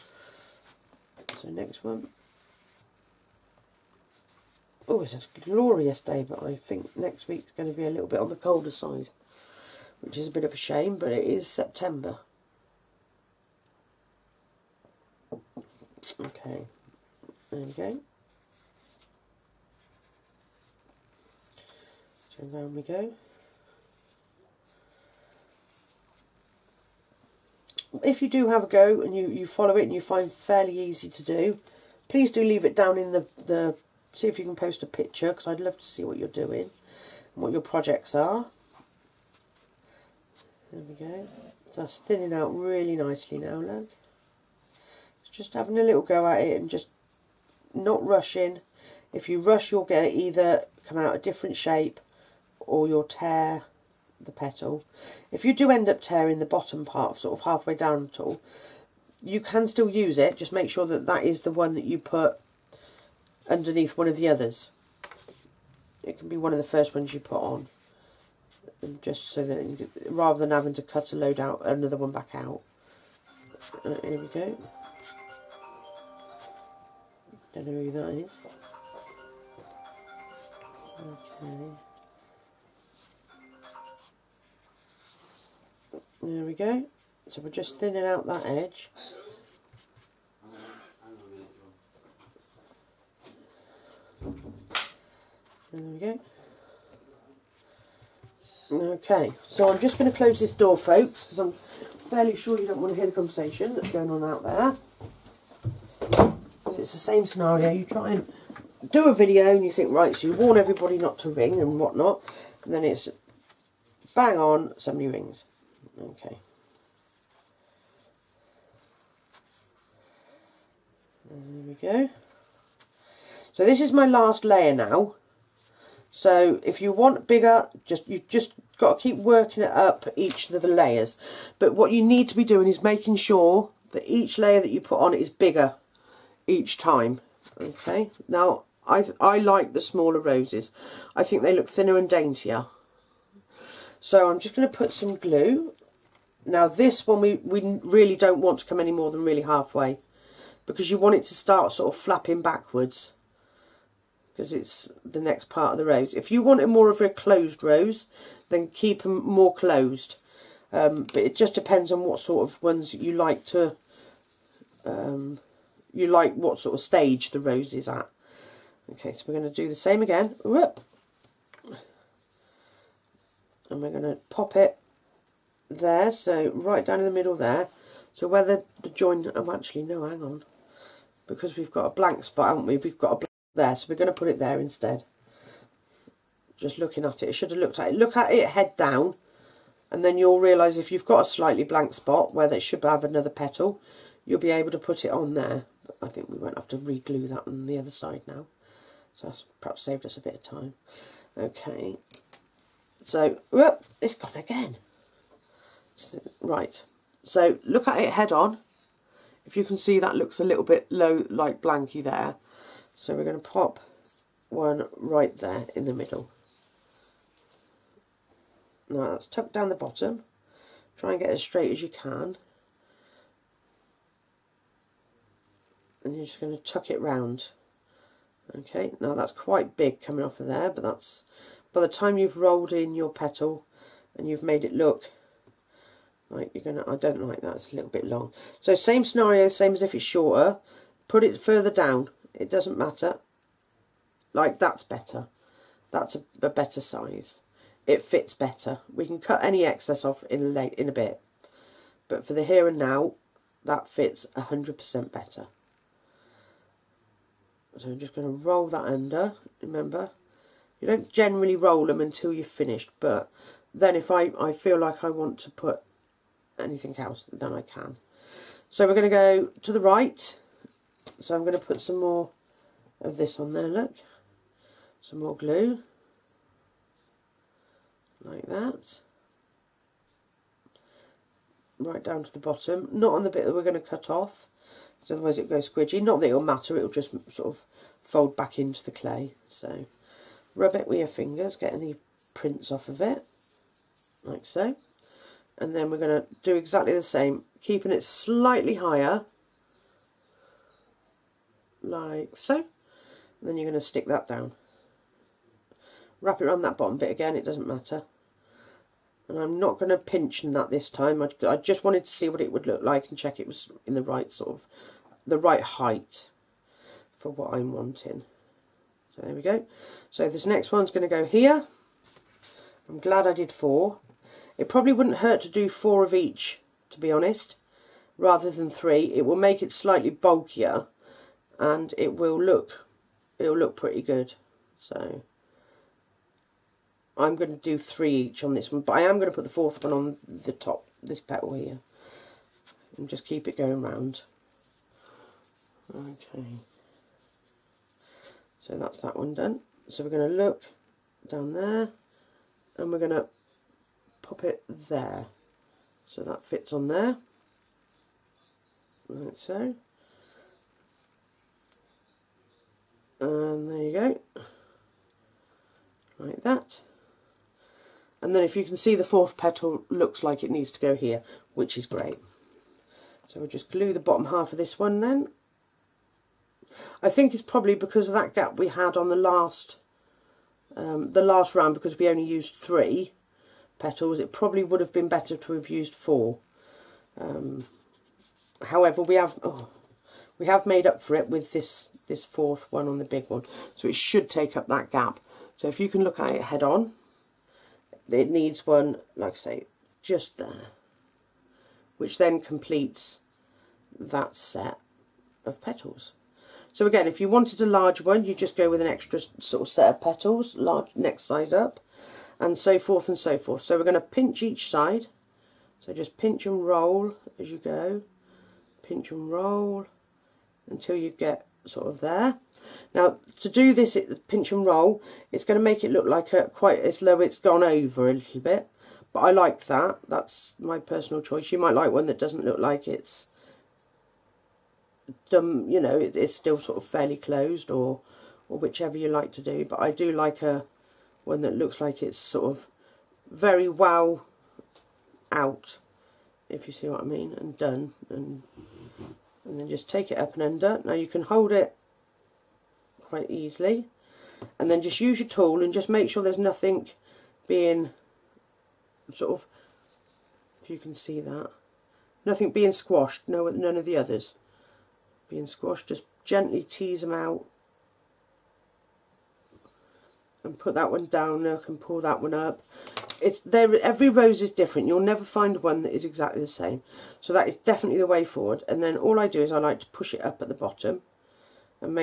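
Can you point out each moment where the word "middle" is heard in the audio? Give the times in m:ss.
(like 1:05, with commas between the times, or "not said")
2:57, 3:35.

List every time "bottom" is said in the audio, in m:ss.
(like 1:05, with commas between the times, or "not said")
0:56, 3:39, 4:42, 5:06, 6:13, 8:00.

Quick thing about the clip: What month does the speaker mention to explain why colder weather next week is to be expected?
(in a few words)
September.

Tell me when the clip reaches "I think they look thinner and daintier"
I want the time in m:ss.
2:21.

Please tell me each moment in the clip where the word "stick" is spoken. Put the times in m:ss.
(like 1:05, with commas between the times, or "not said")
5:03.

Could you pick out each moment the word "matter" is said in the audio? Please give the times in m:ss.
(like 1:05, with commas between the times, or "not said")
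4:02, 4:46, 5:07.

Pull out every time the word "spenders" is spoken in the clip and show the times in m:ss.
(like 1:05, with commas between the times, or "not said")
not said.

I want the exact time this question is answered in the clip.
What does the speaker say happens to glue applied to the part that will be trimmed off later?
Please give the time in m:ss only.
4:45.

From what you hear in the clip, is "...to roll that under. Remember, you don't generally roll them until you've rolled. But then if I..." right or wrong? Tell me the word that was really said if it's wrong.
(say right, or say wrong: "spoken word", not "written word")
wrong: "finished", not "rolled".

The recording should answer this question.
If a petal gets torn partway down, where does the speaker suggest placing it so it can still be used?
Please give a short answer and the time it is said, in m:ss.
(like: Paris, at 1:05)
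underneath one of the others, at 1:03.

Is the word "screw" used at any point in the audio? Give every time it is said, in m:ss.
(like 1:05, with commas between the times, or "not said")
not said.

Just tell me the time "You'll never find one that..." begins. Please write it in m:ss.
7:54.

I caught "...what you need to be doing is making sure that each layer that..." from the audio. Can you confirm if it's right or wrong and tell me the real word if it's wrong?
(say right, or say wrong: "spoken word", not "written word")
right.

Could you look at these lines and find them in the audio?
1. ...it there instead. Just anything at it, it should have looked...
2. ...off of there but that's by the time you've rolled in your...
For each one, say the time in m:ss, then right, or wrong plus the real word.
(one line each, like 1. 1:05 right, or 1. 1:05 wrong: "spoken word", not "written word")
1. 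3:04 wrong: "looking", not "anything"
2. 3:50 right.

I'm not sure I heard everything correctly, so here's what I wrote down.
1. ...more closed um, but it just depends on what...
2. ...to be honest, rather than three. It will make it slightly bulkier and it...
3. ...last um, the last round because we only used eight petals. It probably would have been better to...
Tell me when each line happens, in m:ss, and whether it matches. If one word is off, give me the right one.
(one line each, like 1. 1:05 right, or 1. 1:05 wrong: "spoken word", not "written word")
1. 2:39 right
2. 5:26 right
3. 6:19 wrong: "three", not "eight".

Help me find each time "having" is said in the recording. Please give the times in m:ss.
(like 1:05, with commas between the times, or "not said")
0:45, 1:10.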